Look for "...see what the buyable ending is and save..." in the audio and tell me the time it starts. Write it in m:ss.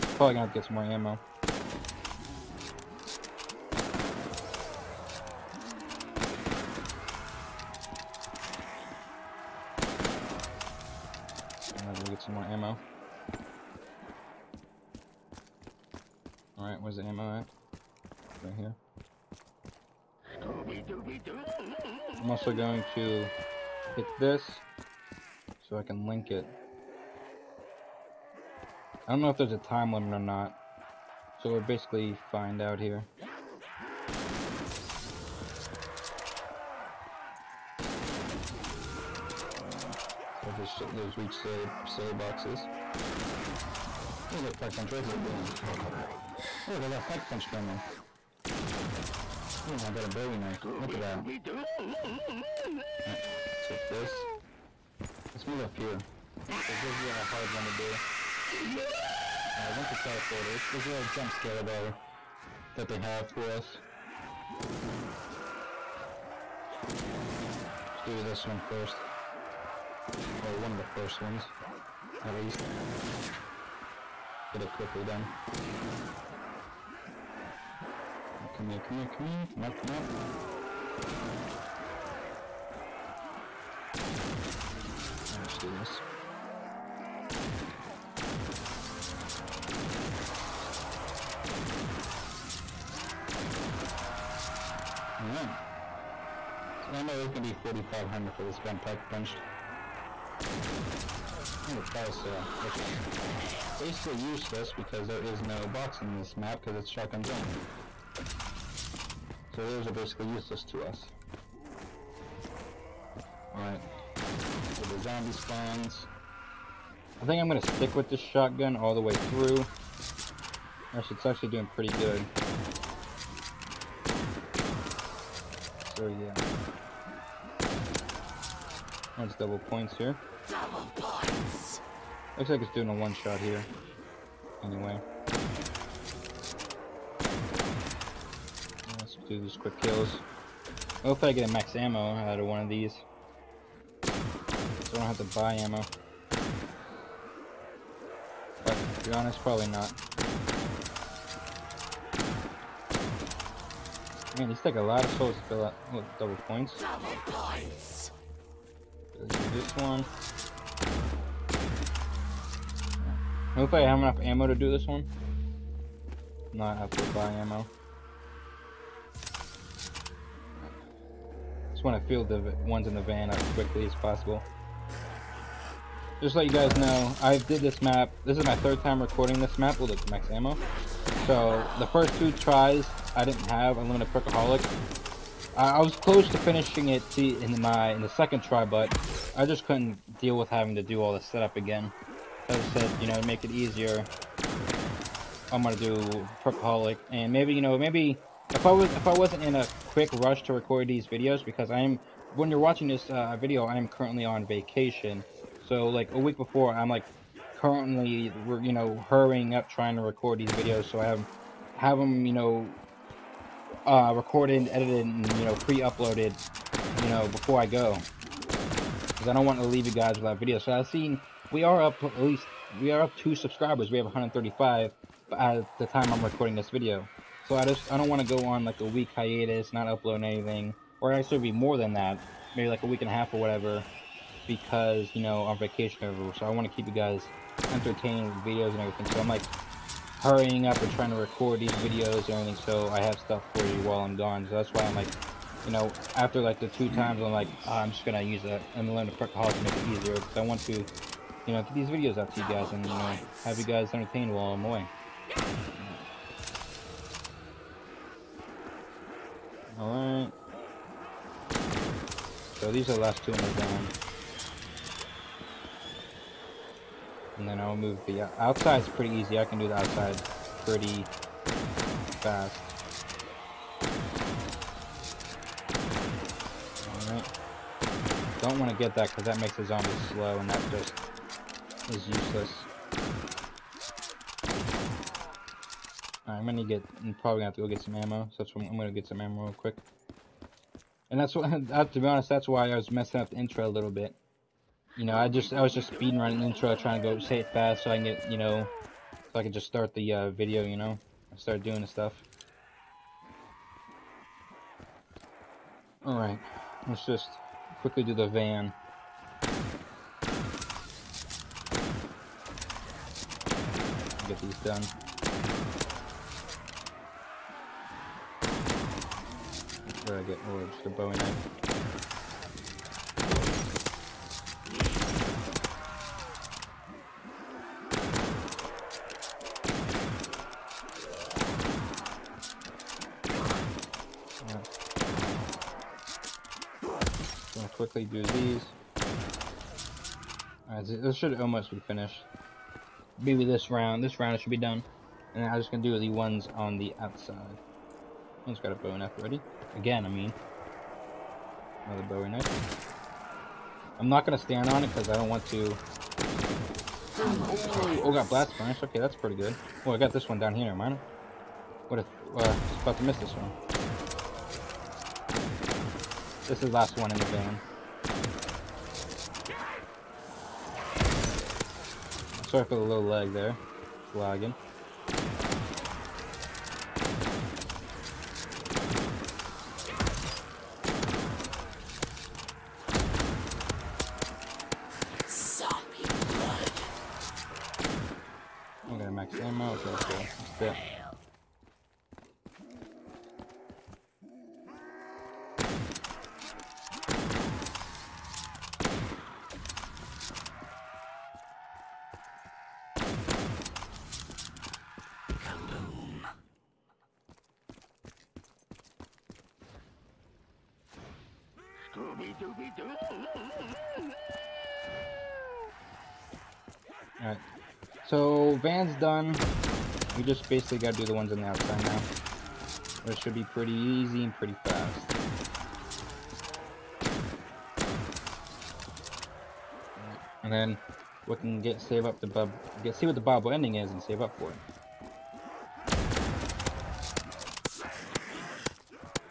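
7:12.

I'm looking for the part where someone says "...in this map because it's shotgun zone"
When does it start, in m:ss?
1:46.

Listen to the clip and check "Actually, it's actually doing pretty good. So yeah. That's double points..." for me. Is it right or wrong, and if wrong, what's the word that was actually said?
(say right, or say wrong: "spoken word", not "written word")
right.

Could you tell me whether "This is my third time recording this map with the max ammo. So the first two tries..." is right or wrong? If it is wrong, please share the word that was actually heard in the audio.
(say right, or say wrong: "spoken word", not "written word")
right.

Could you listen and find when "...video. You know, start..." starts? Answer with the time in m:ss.
5:00.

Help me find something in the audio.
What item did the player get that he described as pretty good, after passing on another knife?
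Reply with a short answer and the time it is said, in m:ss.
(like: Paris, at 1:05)
Blast Furnace, at 5:58.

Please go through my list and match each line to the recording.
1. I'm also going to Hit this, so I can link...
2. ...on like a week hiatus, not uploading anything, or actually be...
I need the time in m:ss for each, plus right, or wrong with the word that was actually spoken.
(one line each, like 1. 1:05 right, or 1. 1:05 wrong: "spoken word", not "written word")
1. 0:22 right
2. 3:48 right.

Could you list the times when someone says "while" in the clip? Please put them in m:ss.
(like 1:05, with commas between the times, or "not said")
4:03, 4:14.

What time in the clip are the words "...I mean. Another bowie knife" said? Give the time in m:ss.
5:50.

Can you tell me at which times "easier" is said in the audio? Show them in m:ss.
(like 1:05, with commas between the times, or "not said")
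3:13, 4:10.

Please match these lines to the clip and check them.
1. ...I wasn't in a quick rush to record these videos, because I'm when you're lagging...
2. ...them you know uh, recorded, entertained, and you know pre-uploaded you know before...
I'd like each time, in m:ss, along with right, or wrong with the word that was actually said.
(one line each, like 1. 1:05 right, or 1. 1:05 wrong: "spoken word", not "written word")
1. 3:19 wrong: "watching", not "lagging"
2. 3:31 wrong: "edited", not "entertained".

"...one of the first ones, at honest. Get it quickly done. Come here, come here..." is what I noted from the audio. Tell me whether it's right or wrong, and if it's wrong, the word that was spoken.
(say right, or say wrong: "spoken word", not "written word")
wrong: "least", not "honest".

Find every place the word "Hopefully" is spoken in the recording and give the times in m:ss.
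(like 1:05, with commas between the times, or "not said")
2:21, 2:43.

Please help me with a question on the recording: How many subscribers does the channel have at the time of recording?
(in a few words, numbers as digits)
135.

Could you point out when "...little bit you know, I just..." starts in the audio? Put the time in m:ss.
4:53.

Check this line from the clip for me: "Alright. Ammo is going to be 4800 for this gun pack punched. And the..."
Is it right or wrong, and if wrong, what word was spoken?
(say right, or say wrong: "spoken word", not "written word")
wrong: "4500", not "4800".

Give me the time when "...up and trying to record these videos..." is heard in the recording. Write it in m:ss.
4:00.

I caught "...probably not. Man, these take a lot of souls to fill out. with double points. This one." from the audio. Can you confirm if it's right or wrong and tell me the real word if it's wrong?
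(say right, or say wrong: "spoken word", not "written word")
right.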